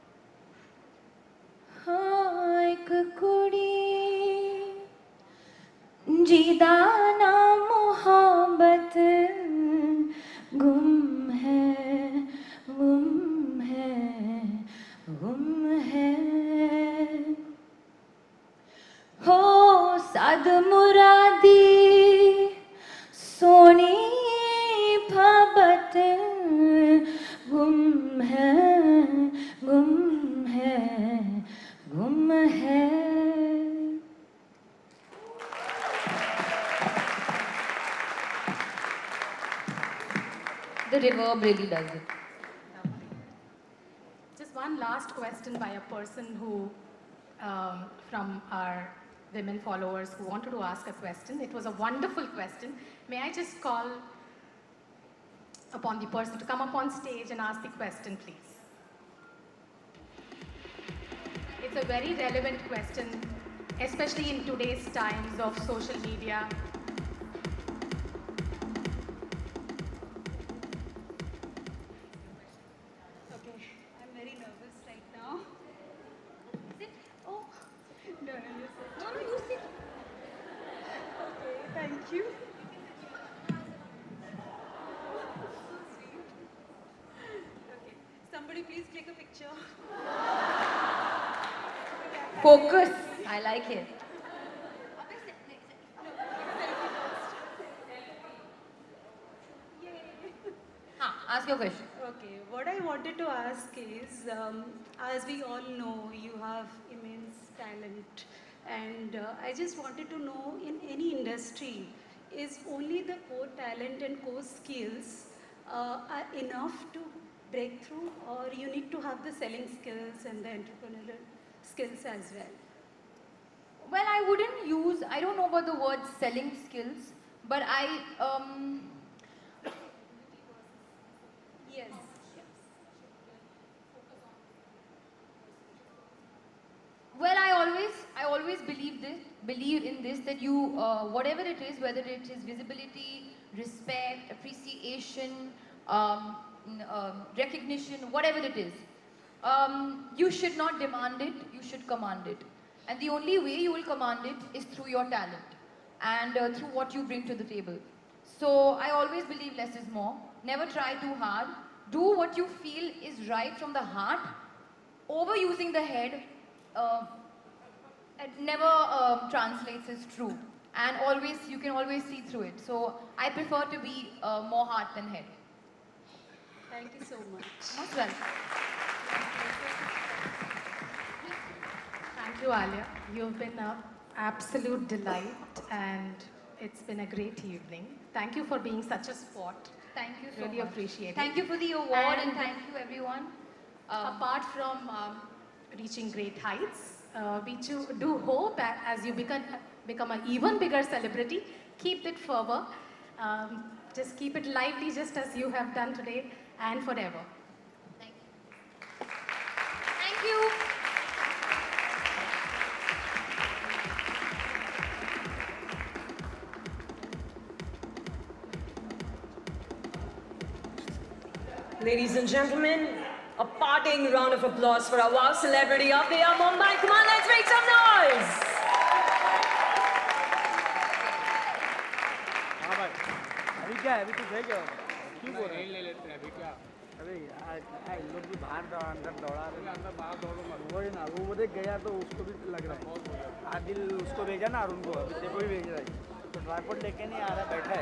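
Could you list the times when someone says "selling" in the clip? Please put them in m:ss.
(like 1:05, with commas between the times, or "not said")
1:59, 2:06.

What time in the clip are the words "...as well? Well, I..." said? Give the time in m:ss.
2:02.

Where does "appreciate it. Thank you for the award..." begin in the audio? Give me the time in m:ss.
3:10.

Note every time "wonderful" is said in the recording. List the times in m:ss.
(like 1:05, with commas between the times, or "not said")
0:51.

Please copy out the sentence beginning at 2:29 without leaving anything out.
Um, you should not demand it, you should command it.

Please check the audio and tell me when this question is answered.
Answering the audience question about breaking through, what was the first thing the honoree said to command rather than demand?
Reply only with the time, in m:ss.
2:22.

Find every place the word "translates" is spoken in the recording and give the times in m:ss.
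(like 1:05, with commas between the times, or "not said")
2:49.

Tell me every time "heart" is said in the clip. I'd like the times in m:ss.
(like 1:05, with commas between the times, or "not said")
2:43, 2:54.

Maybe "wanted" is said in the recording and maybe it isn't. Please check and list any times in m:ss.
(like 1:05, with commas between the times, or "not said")
0:50, 1:42, 1:49.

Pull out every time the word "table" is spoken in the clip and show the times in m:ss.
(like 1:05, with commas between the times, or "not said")
2:37.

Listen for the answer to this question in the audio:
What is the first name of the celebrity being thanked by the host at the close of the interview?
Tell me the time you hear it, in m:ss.
3:02.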